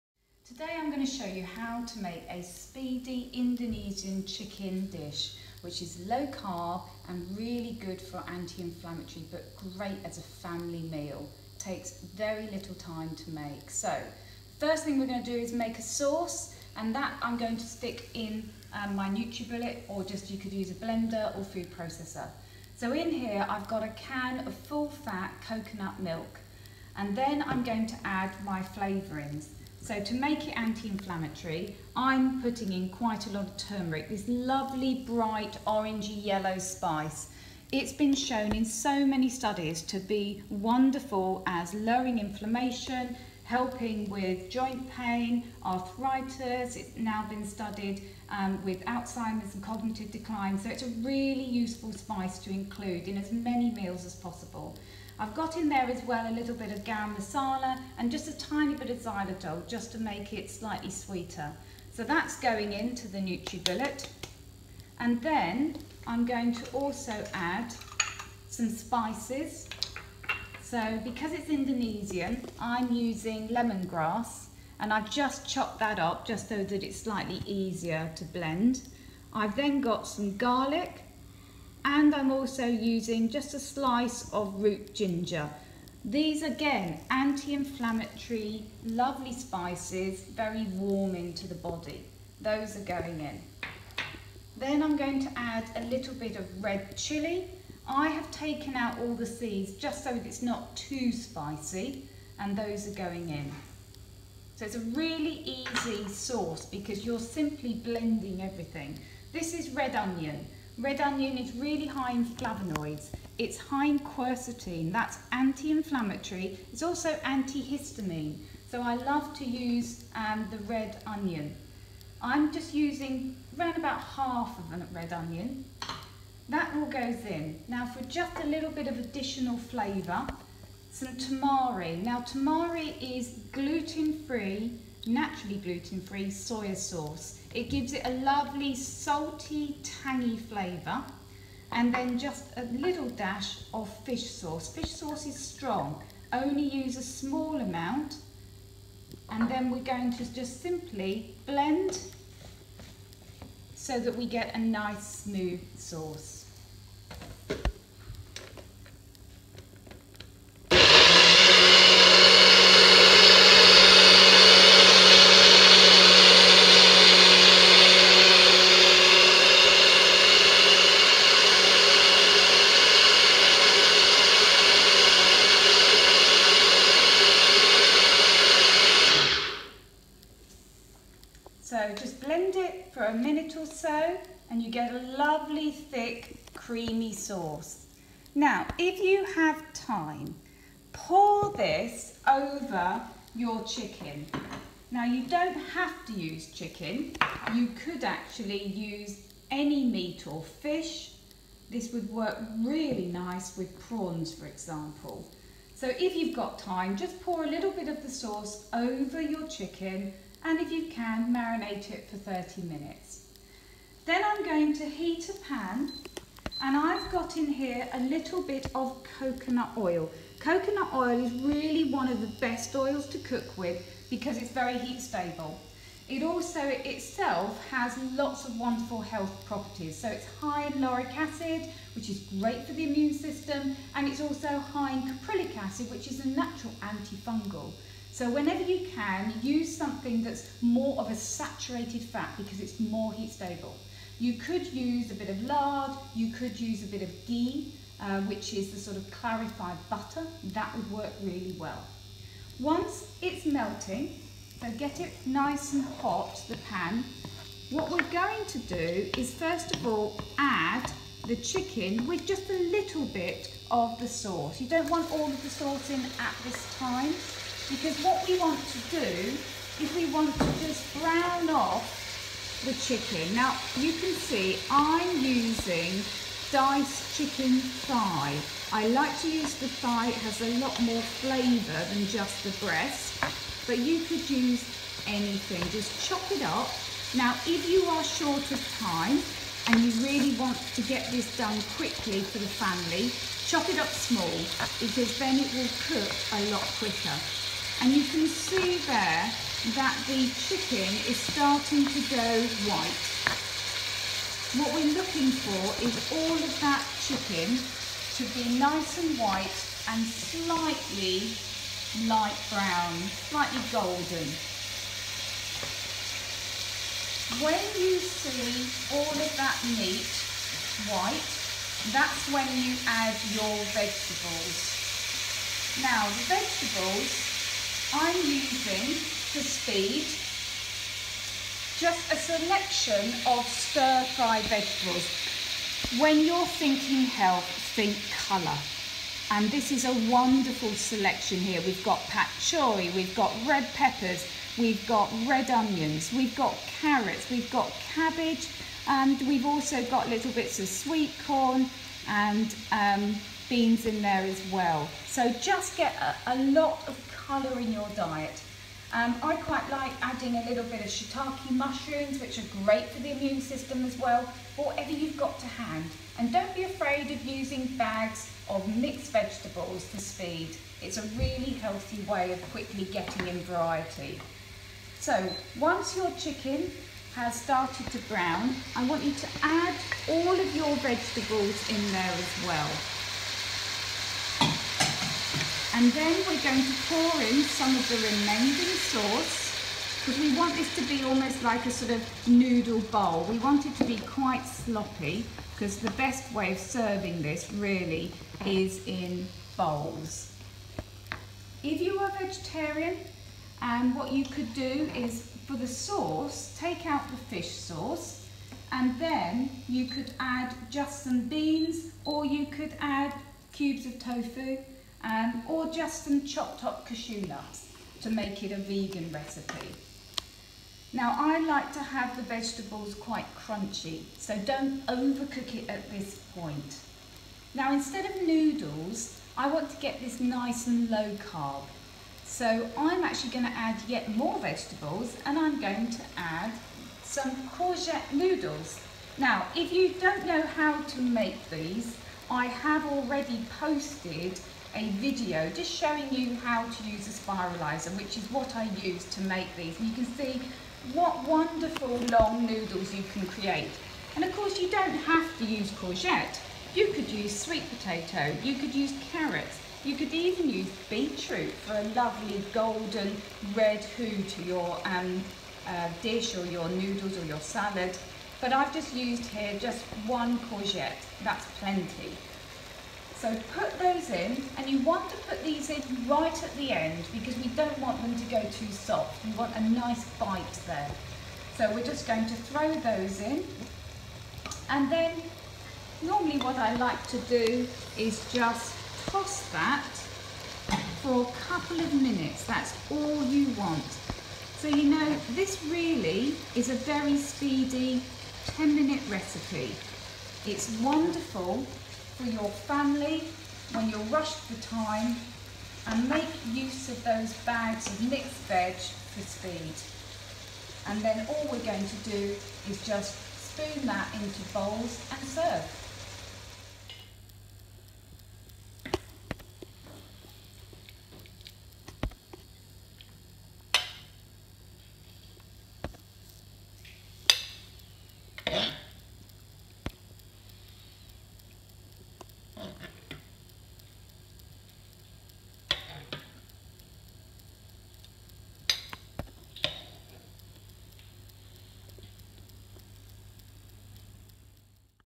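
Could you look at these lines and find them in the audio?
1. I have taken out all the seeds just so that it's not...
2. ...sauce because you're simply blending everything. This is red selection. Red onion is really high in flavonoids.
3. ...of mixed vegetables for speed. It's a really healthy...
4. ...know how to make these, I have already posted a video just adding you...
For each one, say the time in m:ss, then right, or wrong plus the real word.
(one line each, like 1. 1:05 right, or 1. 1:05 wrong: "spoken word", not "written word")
1. 1:37 right
2. 1:46 wrong: "onion", not "selection"
3. 6:08 right
4. 7:20 wrong: "showing", not "adding".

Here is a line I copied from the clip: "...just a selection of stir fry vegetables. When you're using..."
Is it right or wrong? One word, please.
wrong.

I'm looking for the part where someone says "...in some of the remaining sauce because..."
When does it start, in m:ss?
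6:27.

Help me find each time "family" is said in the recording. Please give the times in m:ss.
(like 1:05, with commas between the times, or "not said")
0:10, 4:52, 8:22.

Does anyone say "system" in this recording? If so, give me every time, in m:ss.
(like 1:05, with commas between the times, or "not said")
3:53, 6:03.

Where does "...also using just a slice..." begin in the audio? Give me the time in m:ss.
1:22.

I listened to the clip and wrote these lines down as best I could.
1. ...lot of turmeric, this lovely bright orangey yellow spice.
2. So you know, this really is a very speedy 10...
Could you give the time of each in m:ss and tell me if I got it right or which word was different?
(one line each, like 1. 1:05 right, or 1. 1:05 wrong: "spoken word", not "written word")
1. 0:33 right
2. 8:14 right.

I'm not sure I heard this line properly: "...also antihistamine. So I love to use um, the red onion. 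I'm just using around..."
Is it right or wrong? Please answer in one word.
right.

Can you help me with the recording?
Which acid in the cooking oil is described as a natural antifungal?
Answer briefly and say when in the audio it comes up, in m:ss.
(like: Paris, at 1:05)
caprylic acid, at 3:55.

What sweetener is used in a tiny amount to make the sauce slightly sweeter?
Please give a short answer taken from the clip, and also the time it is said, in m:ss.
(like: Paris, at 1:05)
xylitol, at 0:58.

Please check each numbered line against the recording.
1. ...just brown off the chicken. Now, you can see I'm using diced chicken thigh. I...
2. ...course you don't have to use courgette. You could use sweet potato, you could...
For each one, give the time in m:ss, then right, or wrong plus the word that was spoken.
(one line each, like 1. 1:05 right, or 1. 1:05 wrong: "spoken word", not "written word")
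1. 4:30 right
2. 7:34 right.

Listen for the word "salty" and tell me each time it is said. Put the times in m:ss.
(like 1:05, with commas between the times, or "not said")
2:18.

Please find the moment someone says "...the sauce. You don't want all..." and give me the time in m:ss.
4:24.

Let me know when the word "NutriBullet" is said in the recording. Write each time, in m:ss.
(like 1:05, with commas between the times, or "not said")
0:19, 1:03.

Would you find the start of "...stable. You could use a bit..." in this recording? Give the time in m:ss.
4:03.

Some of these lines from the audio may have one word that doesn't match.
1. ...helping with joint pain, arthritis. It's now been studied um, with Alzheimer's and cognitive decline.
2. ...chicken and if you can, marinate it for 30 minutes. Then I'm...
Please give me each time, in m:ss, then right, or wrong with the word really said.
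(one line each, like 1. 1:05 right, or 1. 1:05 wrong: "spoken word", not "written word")
1. 0:43 right
2. 3:29 right.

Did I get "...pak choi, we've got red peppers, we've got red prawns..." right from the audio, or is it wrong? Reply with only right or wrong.
wrong.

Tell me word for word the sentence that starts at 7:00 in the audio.
Now I like to have the vegetables quite crunchy, so don't overcook it at this point.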